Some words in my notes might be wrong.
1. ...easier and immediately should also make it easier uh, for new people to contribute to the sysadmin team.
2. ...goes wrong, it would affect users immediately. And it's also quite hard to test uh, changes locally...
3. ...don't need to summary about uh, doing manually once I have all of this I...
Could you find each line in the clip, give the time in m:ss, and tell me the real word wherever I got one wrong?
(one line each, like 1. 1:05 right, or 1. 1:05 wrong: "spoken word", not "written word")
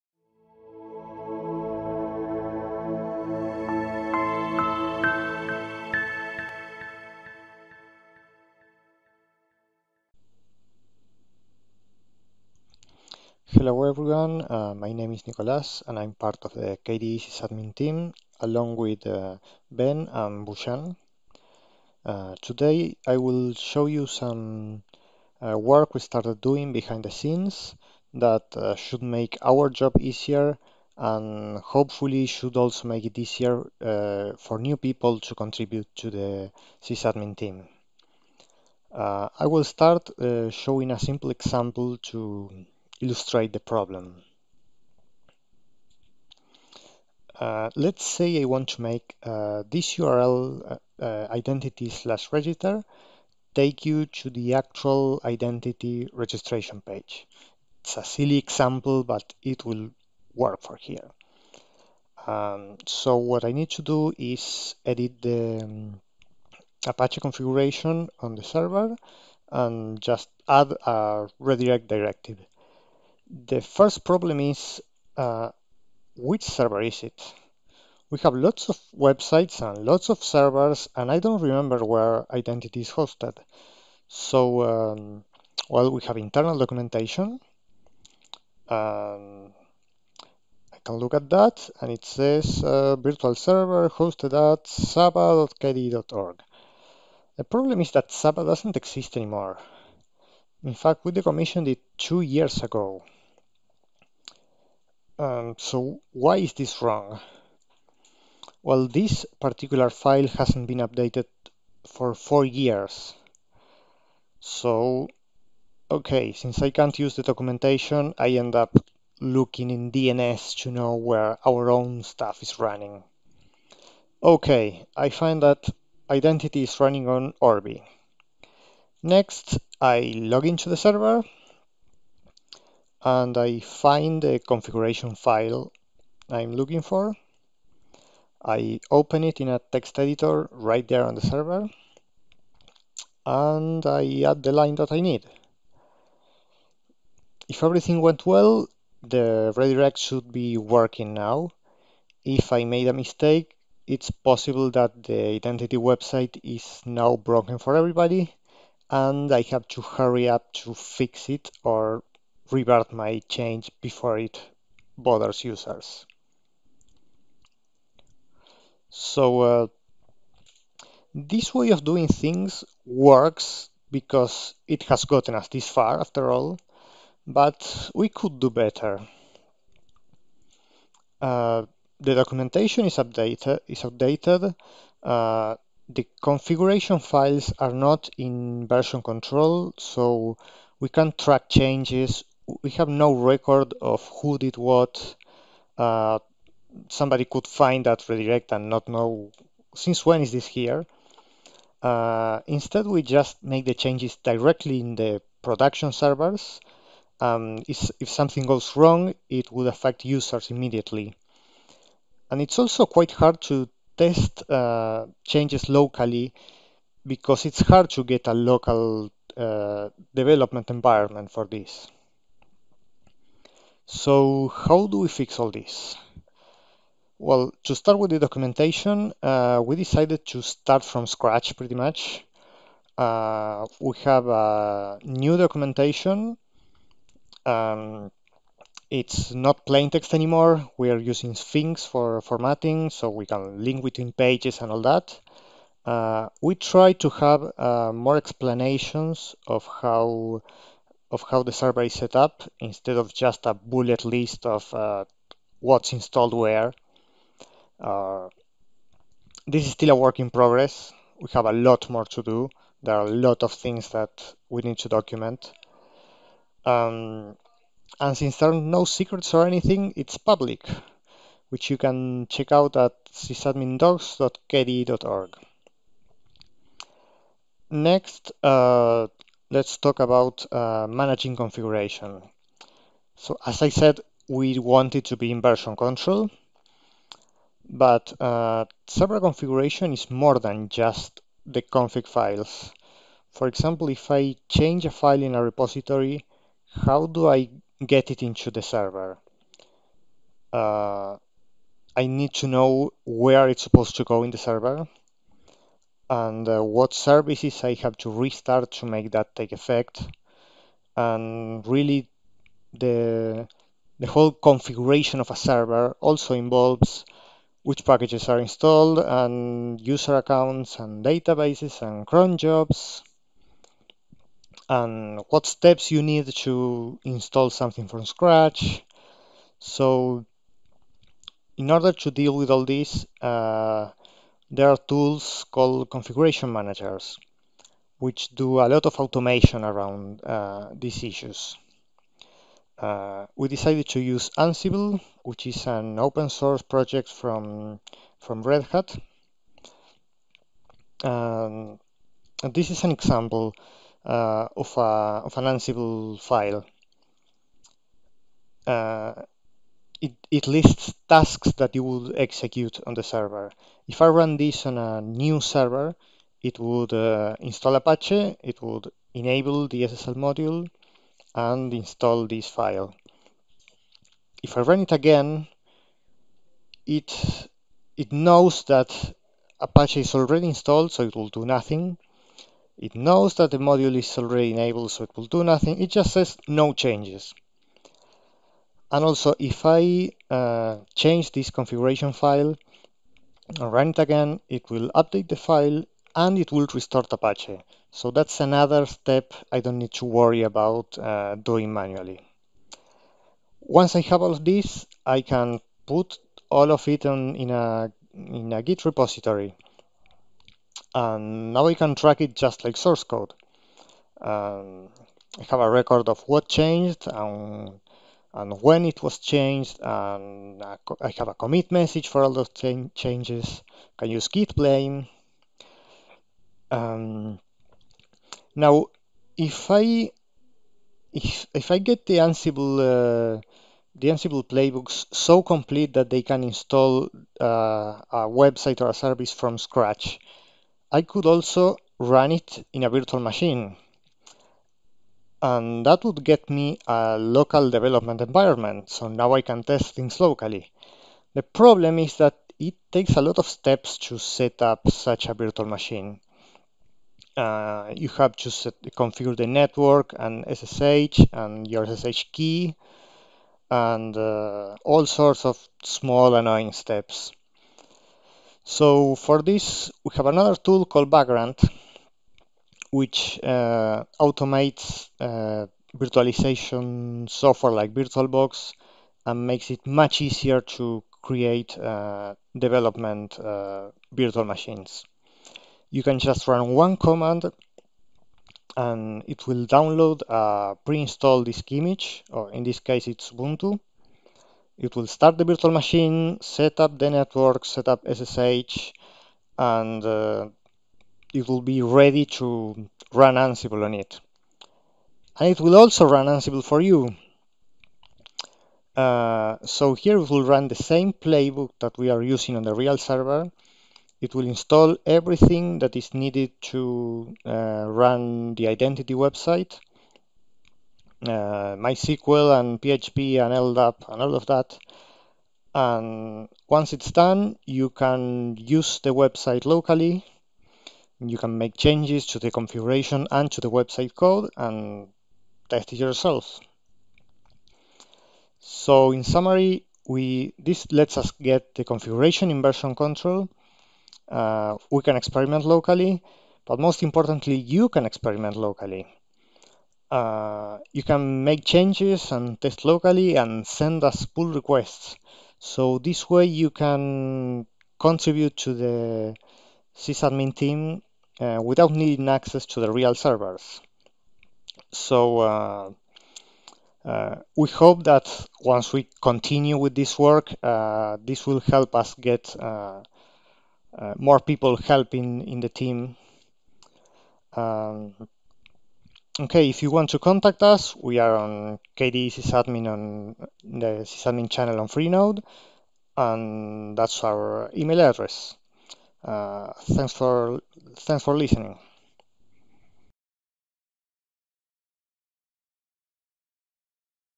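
1. 0:29 wrong: "hopefully", not "immediately"
2. 3:28 right
3. 6:39 wrong: "worry", not "summary".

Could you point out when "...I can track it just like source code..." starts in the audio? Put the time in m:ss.
6:51.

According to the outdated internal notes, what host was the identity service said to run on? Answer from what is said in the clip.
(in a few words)
saba.kde.org.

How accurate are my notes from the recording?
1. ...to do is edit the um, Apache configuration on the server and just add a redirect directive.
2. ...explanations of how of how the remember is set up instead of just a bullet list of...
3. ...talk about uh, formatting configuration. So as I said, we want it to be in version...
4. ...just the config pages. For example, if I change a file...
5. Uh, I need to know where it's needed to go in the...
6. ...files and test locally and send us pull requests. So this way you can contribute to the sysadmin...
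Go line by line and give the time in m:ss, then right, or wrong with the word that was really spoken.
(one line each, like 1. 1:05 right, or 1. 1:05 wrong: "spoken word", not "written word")
1. 1:03 right
2. 4:08 wrong: "server", not "remember"
3. 4:39 wrong: "managing", not "formatting"
4. 4:50 wrong: "files", not "pages"
5. 5:00 wrong: "supposed", not "needed"
6. 9:11 wrong: "changes", not "files".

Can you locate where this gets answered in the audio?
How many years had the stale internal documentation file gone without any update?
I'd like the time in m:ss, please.
1:52.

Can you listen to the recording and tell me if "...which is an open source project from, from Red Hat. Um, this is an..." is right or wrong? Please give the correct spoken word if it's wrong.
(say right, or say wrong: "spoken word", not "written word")
right.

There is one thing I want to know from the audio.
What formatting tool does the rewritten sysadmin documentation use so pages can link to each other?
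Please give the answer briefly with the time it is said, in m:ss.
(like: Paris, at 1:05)
Sphinx, at 4:01.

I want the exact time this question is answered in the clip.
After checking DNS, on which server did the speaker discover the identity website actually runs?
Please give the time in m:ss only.
2:07.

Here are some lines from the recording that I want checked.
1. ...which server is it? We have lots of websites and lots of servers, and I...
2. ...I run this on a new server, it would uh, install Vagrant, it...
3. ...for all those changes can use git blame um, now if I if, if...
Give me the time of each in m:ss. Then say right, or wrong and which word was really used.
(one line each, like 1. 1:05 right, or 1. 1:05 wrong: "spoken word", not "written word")
1. 1:16 right
2. 6:04 wrong: "Apache", not "Vagrant"
3. 7:02 right.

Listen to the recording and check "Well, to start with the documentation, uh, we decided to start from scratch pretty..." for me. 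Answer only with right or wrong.
right.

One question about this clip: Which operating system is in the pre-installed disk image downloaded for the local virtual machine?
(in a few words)
Ubuntu.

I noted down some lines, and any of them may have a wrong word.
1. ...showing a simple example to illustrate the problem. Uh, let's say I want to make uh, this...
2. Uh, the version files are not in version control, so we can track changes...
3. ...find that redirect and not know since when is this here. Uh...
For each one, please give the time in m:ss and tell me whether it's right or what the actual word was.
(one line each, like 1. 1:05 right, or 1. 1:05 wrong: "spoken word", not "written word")
1. 0:40 right
2. 3:05 wrong: "configuration", not "version"
3. 3:17 right.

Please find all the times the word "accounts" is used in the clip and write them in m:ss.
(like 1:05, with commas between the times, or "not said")
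5:20.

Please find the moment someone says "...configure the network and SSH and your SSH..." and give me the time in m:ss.
7:38.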